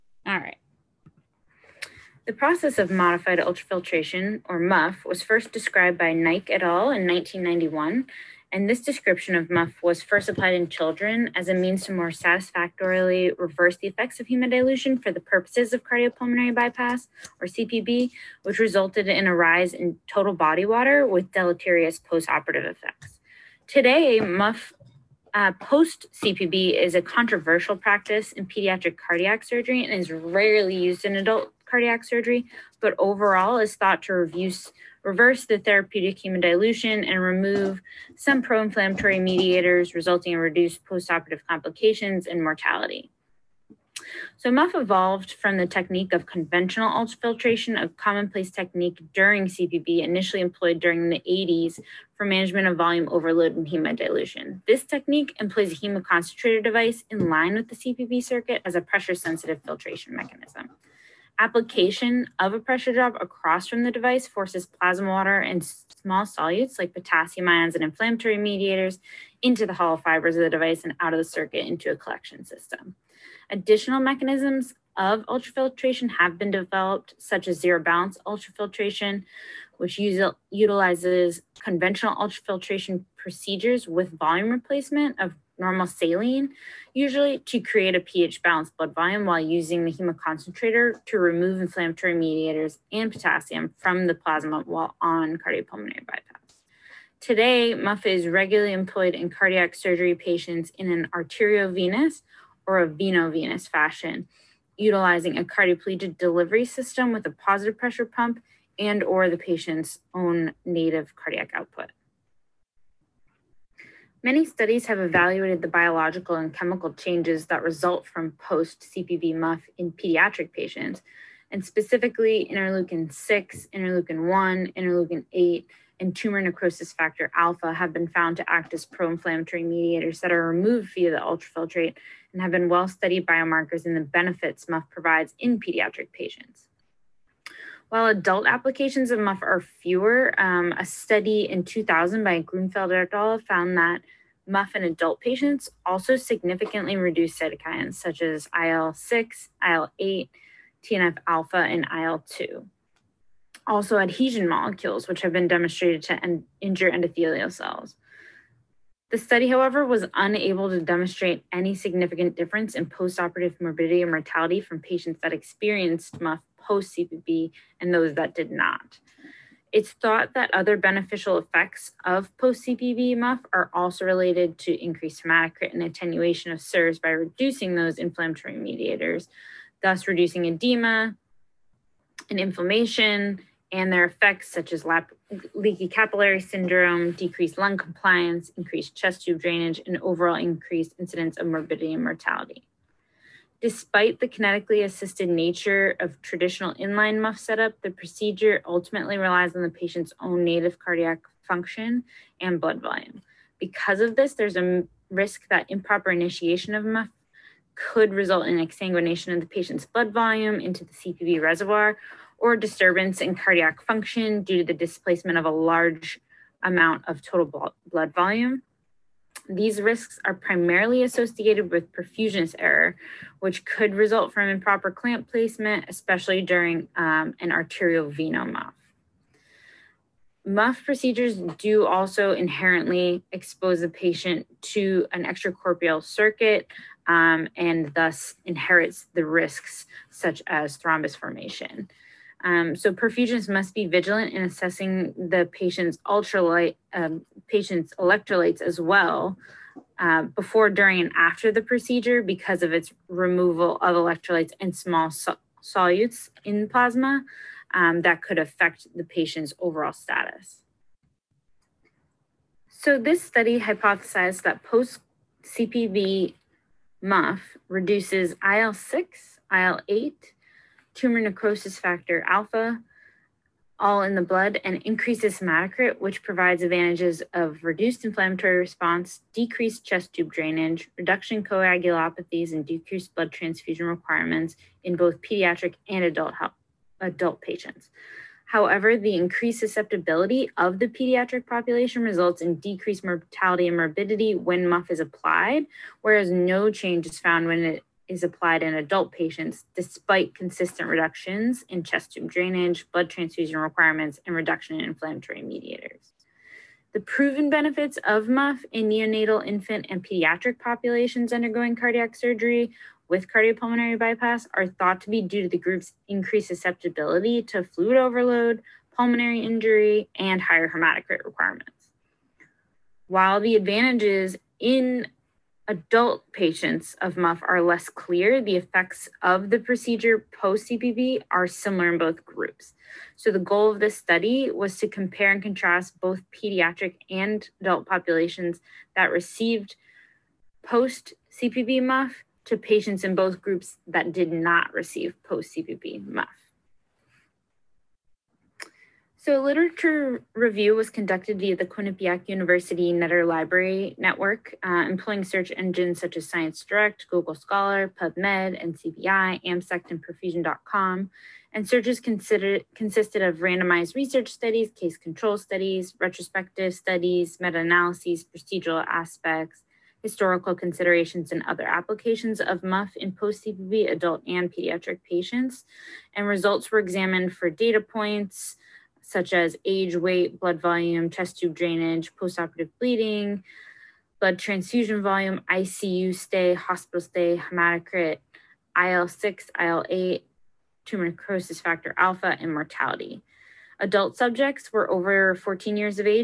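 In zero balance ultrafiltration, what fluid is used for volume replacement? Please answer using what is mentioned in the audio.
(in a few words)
normal saline.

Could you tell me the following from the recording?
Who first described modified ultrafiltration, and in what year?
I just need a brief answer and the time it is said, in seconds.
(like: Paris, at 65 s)
Naik et al., 1991, at 6 s.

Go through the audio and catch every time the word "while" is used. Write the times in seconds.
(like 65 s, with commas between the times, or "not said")
89 s, 94 s, 137 s, 323 s.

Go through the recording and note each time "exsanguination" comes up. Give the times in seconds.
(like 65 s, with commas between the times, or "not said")
208 s.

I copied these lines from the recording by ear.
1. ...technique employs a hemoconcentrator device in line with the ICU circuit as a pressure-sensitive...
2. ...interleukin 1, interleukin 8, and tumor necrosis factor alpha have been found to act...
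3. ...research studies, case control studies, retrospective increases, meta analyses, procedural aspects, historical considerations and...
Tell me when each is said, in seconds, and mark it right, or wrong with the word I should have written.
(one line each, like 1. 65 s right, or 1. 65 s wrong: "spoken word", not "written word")
1. 54 s wrong: "CPB", not "ICU"
2. 123 s right
3. 363 s wrong: "studies", not "increases".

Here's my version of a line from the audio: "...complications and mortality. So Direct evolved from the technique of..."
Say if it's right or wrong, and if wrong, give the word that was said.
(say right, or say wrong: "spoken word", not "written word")
wrong: "MUF", not "Direct".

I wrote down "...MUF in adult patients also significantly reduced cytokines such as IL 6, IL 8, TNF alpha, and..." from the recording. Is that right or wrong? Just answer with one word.
right.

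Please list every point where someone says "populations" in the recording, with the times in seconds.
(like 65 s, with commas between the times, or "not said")
291 s, 310 s, 337 s.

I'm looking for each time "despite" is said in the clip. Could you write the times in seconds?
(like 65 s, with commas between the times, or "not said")
193 s, 299 s.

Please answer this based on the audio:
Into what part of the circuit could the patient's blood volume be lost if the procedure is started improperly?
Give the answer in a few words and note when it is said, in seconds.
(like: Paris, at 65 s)
CPB reservoir, at 210 s.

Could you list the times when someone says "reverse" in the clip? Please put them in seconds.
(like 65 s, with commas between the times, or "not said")
13 s, 35 s.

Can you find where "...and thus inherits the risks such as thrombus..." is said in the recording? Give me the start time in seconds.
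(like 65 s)
237 s.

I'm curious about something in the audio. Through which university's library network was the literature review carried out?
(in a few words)
Quinnipiac University.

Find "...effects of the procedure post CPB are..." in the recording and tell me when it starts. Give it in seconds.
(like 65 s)
328 s.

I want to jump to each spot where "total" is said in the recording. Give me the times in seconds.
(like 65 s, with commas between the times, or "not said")
20 s, 217 s.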